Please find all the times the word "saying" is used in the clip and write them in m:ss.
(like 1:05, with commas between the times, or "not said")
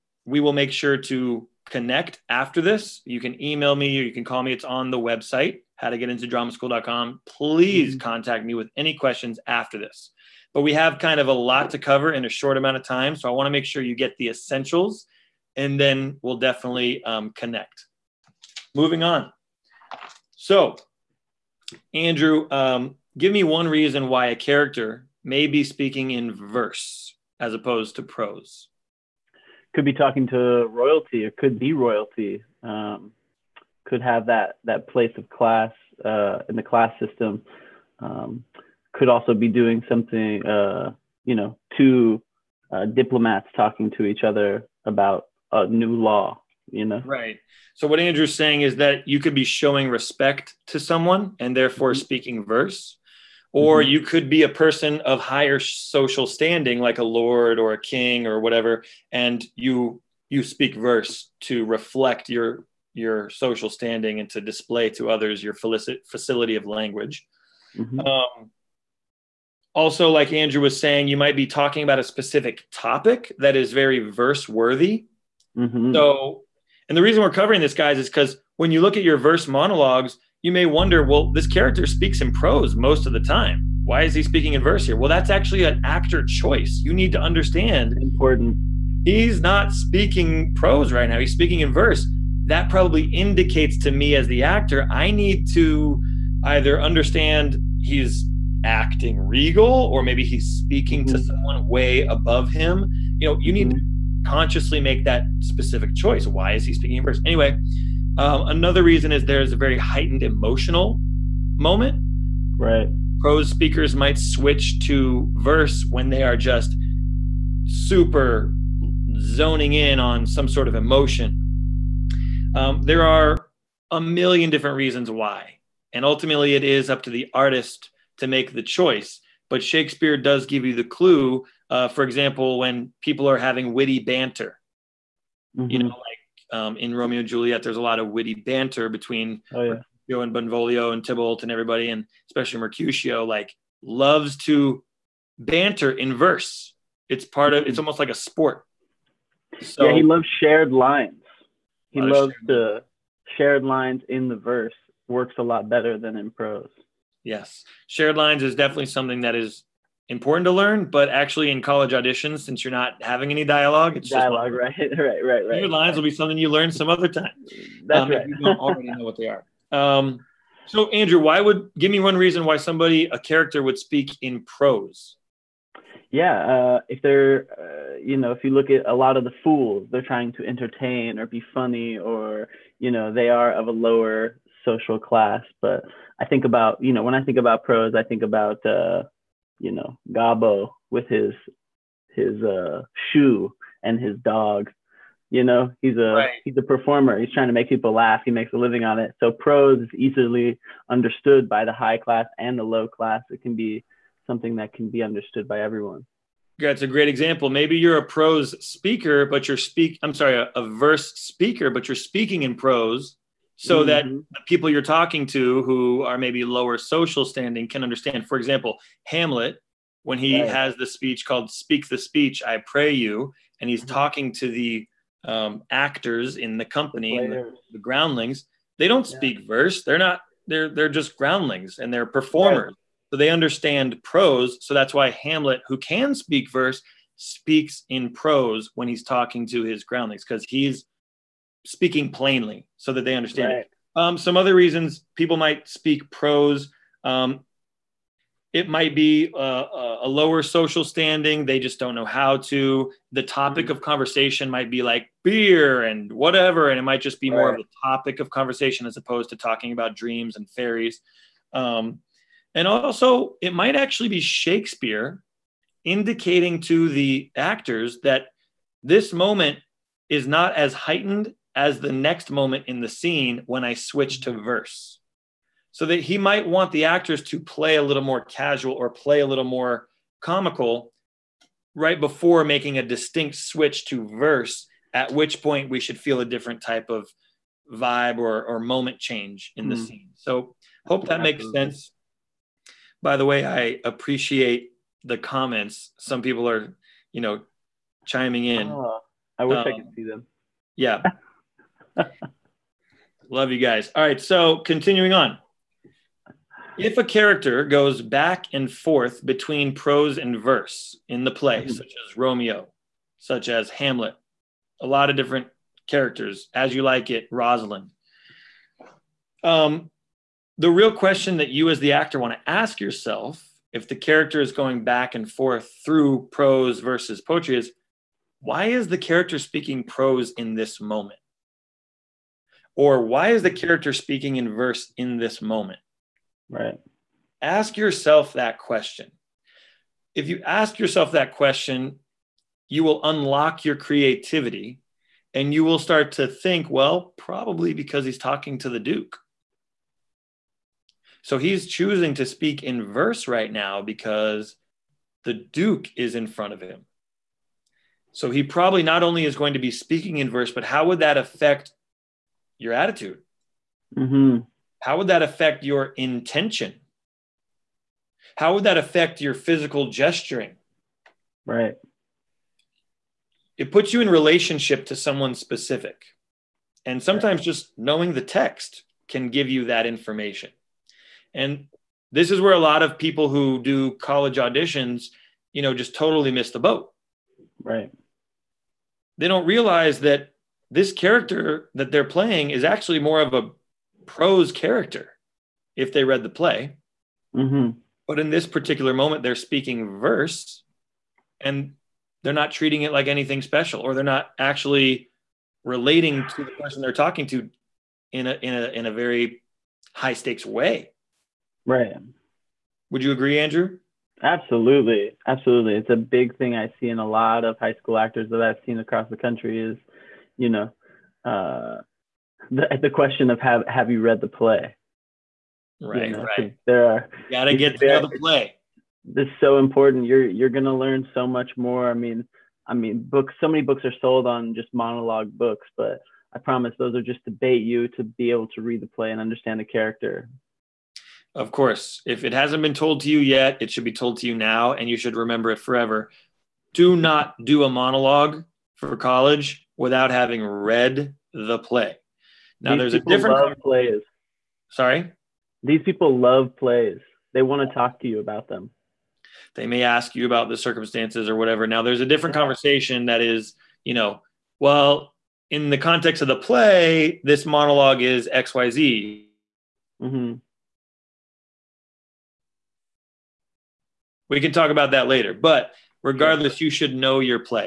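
0:48, 1:10.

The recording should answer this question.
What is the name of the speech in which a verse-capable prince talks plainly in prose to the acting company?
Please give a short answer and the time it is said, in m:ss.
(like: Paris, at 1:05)
Speak the Speech, I Pray You, at 3:41.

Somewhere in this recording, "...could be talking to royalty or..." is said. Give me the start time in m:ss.
0:29.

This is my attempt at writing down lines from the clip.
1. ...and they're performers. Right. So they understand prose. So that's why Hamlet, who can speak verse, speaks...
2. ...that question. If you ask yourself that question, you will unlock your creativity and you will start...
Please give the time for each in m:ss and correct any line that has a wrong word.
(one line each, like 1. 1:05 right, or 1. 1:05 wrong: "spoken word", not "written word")
1. 3:51 right
2. 5:38 right.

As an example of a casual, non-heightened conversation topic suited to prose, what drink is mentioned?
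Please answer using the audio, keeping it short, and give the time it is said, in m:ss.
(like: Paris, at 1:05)
beer, at 4:15.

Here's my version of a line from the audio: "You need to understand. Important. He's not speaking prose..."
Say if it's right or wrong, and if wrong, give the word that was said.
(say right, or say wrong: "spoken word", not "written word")
right.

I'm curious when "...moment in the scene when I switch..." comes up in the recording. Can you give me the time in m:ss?
4:32.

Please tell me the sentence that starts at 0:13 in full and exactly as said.
So I want to make sure you get the essentials and then we'll definitely um, connect.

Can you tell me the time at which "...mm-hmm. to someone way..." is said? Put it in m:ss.
1:41.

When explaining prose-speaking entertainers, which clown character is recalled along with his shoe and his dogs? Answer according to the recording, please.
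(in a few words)
Gobbo.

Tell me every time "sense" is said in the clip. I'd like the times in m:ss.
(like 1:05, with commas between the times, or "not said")
4:51.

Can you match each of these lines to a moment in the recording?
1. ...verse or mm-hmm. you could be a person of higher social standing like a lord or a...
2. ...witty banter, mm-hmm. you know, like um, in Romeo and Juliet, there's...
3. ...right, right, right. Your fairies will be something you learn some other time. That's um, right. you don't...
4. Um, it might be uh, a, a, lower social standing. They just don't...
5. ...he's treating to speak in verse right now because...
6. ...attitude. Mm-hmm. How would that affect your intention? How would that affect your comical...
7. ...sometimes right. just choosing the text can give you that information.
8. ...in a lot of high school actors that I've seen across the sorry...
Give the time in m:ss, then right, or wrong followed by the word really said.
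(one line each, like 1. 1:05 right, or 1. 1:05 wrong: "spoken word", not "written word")
1. 0:52 right
2. 2:13 right
3. 2:44 wrong: "lines", not "fairies"
4. 4:07 right
5. 5:51 wrong: "choosing", not "treating"
6. 6:02 wrong: "physical", not "comical"
7. 6:17 wrong: "knowing", not "choosing"
8. 6:56 wrong: "country", not "sorry".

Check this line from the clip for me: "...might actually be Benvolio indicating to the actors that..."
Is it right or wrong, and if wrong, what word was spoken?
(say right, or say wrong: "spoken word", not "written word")
wrong: "Shakespeare", not "Benvolio".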